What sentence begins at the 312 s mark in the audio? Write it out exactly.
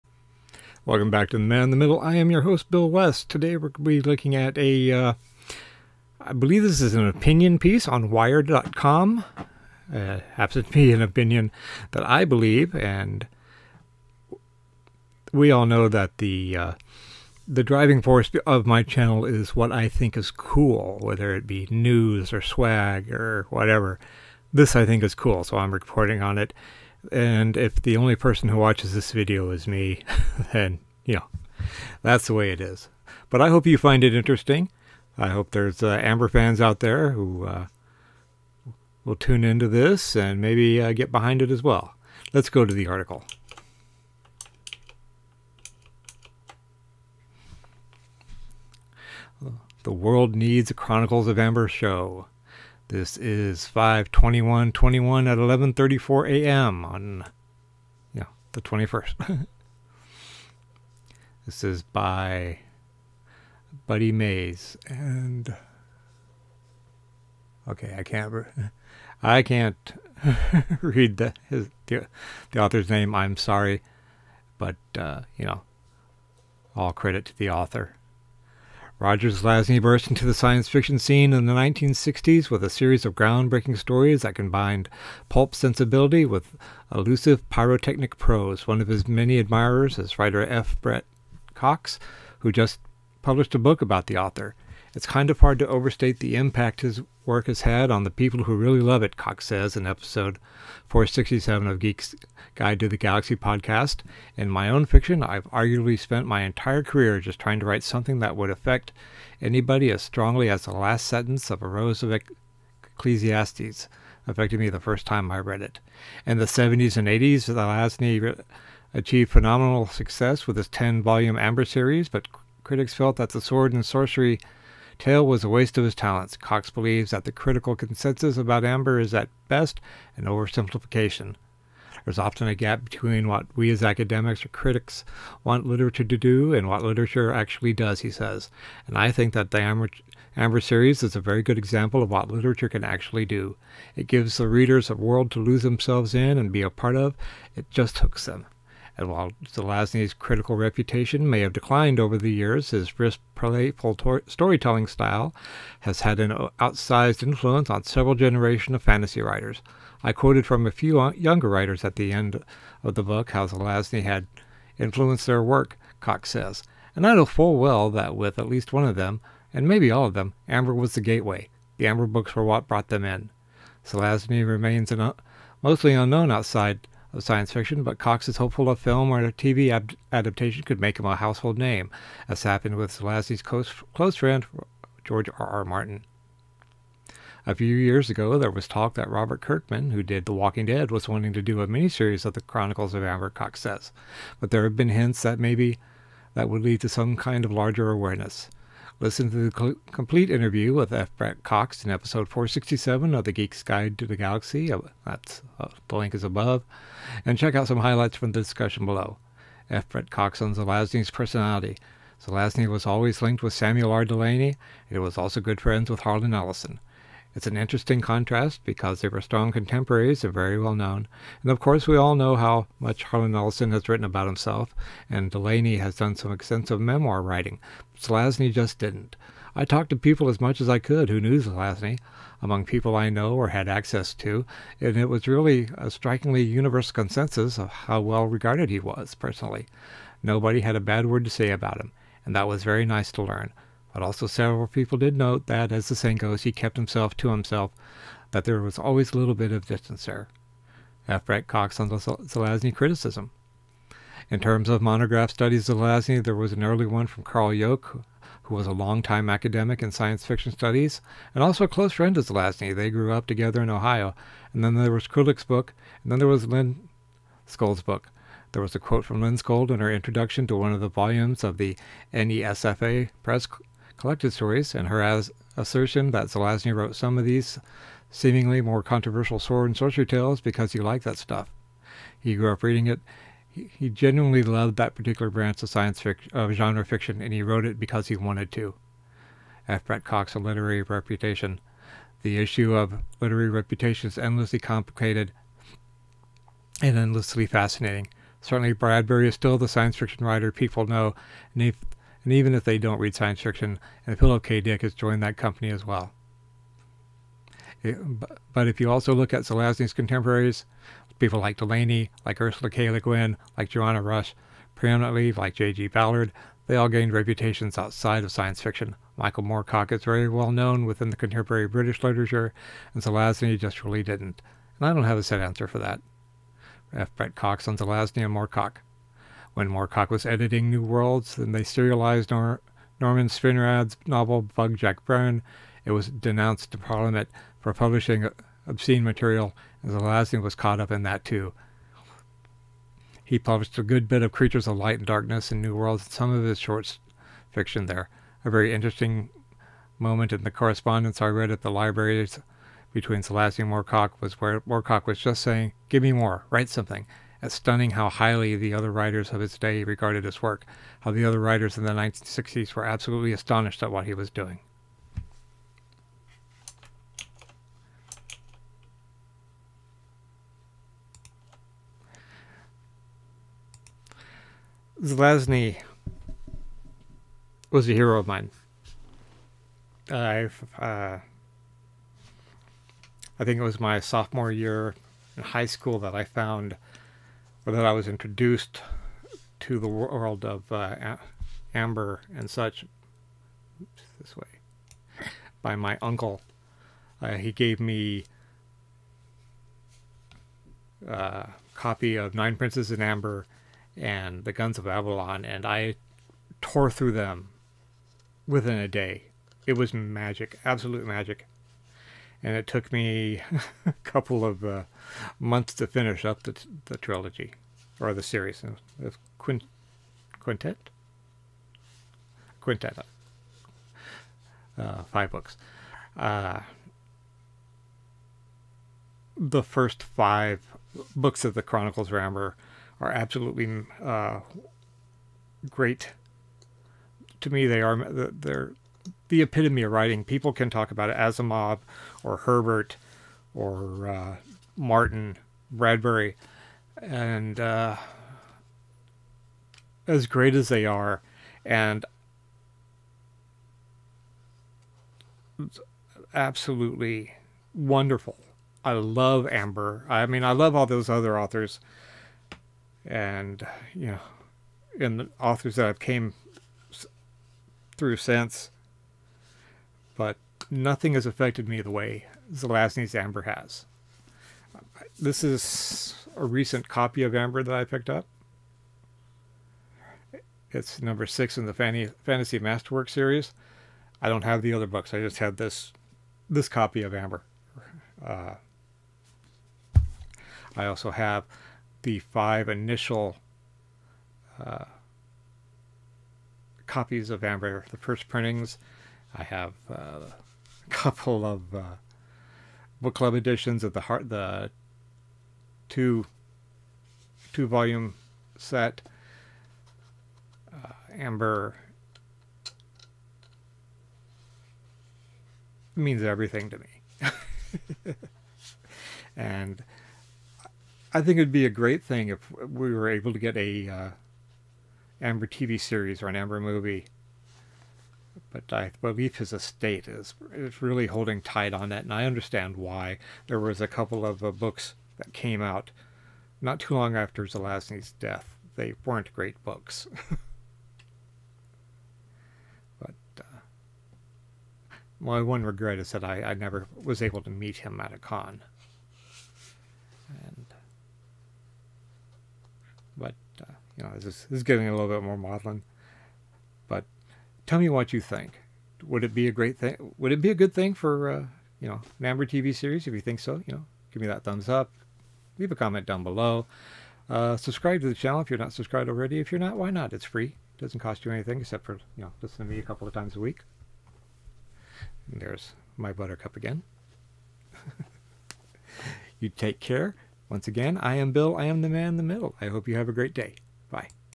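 Le Guin, like Joanna Russ, preeminently like J.G.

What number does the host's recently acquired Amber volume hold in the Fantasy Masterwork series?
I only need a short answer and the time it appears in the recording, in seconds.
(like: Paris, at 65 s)
6, at 481 s.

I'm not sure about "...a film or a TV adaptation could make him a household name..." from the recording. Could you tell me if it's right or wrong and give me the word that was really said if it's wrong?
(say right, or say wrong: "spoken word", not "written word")
right.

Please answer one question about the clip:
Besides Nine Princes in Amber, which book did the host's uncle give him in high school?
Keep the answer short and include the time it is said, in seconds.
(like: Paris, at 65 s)
The Guns of Avalon, at 404 s.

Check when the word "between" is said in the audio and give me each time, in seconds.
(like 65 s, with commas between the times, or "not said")
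132 s, 352 s.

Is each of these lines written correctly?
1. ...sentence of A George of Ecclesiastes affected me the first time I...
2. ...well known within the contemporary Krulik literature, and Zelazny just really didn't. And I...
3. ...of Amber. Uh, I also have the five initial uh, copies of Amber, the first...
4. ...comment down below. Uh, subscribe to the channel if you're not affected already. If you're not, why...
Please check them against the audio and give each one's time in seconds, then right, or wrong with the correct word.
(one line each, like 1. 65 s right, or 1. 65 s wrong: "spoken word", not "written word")
1. 111 s wrong: "Rose", not "George"
2. 320 s wrong: "British", not "Krulik"
3. 487 s right
4. 565 s wrong: "subscribed", not "affected".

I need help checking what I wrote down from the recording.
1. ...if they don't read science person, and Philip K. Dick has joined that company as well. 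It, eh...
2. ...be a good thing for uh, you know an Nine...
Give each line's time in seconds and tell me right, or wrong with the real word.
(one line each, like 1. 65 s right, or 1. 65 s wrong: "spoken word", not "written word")
1. 302 s wrong: "fiction", not "person"
2. 560 s wrong: "Amber", not "Nine".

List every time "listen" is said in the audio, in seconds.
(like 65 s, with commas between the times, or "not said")
199 s, 572 s.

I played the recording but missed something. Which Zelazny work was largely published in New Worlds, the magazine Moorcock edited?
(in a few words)
Creatures of Light and Darkness.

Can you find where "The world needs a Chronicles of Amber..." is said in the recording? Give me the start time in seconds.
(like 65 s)
49 s.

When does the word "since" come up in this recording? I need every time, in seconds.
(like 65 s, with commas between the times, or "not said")
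468 s.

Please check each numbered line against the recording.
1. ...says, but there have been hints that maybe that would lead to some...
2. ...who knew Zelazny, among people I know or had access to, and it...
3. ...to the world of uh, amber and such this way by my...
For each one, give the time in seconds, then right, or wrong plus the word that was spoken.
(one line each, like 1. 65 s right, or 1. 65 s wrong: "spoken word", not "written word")
1. 193 s right
2. 231 s right
3. 389 s right.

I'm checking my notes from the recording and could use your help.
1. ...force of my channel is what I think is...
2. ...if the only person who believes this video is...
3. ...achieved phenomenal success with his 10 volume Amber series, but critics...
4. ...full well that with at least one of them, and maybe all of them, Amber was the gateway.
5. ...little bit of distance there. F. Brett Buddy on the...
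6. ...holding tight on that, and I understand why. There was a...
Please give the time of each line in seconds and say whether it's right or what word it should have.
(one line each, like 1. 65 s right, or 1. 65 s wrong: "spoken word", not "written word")
1. 18 s right
2. 27 s wrong: "watches", not "believes"
3. 118 s right
4. 167 s right
5. 249 s wrong: "Cox", not "Buddy"
6. 531 s right.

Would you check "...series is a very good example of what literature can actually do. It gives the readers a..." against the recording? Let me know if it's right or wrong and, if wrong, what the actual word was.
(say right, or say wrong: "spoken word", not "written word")
right.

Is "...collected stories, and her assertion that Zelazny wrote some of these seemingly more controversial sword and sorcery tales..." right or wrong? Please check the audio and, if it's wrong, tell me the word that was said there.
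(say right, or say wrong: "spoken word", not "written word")
right.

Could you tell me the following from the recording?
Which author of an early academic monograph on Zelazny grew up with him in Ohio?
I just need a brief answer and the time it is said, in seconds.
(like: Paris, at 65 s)
Carl Yoke, at 257 s.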